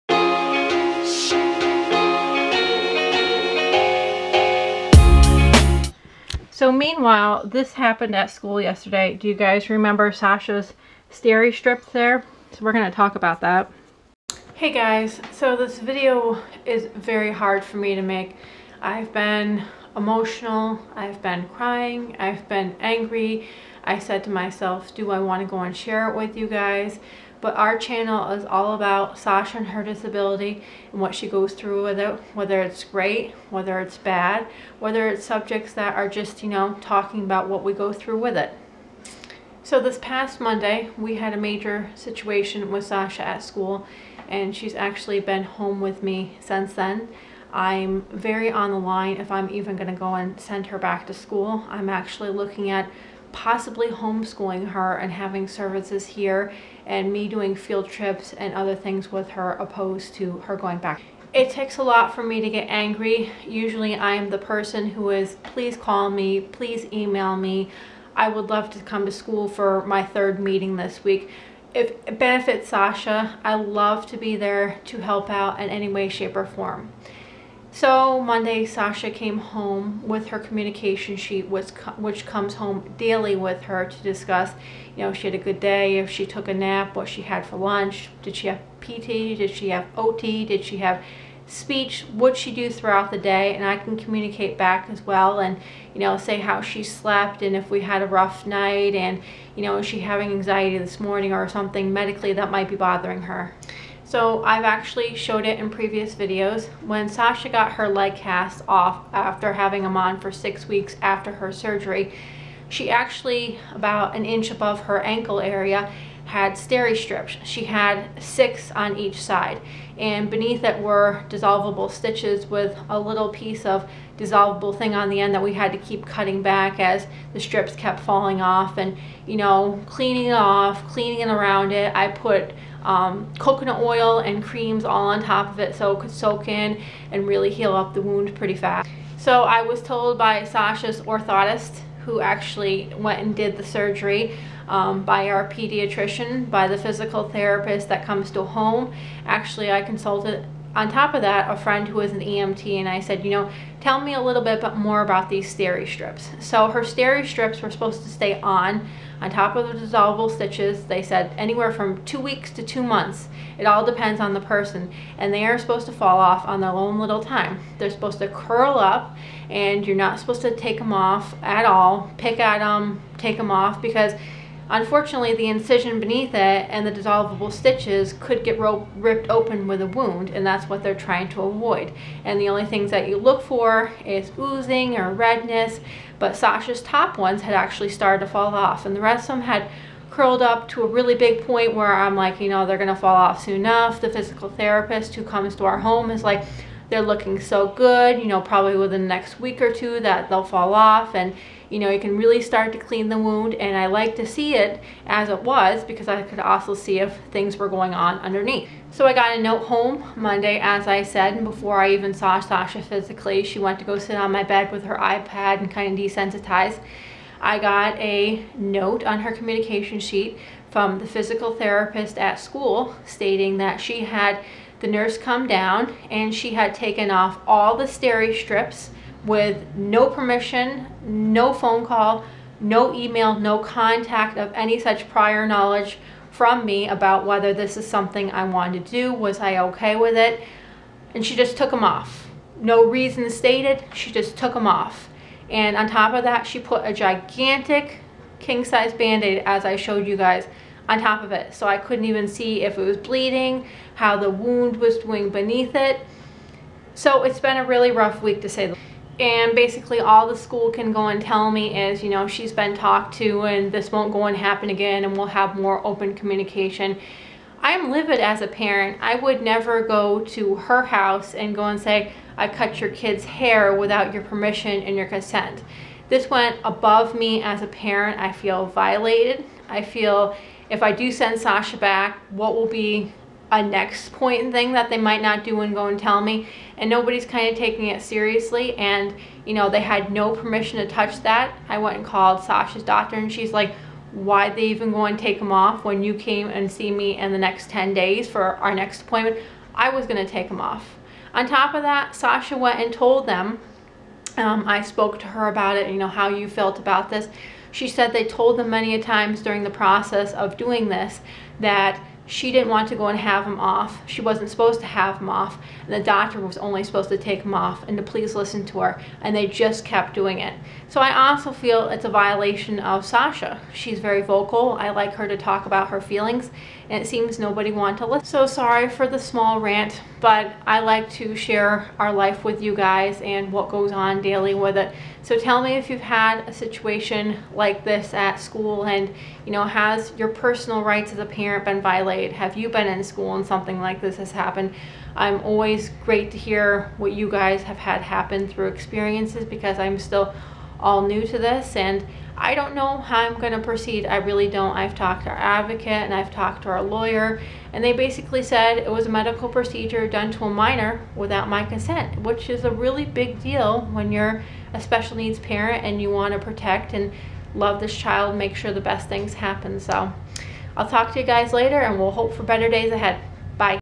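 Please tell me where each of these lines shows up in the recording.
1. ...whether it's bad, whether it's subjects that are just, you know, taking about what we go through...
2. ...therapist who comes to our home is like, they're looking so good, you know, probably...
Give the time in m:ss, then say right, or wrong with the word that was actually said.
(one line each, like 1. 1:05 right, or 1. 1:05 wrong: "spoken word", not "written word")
1. 0:33 wrong: "talking", not "taking"
2. 3:14 right.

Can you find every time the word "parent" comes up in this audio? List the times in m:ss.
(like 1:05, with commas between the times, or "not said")
4:28, 4:37, 5:41, 6:05.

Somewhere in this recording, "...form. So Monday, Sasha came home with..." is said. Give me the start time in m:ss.
1:16.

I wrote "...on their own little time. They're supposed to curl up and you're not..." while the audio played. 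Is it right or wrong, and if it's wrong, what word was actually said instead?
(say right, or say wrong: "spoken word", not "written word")
right.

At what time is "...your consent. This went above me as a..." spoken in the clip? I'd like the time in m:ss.
4:34.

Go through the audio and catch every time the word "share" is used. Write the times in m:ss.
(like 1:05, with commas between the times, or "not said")
0:25, 5:31.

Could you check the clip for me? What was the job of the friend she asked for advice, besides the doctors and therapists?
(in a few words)
EMT.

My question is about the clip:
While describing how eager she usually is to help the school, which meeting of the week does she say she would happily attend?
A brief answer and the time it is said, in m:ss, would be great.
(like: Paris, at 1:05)
third meeting, at 1:10.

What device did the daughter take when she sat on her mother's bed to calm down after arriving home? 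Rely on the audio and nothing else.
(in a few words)
iPad.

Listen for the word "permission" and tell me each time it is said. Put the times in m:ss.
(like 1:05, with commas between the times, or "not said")
3:50, 4:34, 4:50.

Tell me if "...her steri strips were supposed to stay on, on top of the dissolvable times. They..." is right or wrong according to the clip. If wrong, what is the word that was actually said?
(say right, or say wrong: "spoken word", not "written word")
wrong: "stitches", not "times".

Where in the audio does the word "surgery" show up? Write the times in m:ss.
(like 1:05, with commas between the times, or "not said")
1:51, 2:23.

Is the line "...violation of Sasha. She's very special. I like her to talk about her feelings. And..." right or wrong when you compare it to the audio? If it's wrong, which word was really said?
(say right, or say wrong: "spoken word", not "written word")
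wrong: "vocal", not "special".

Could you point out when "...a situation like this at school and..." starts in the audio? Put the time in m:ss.
5:36.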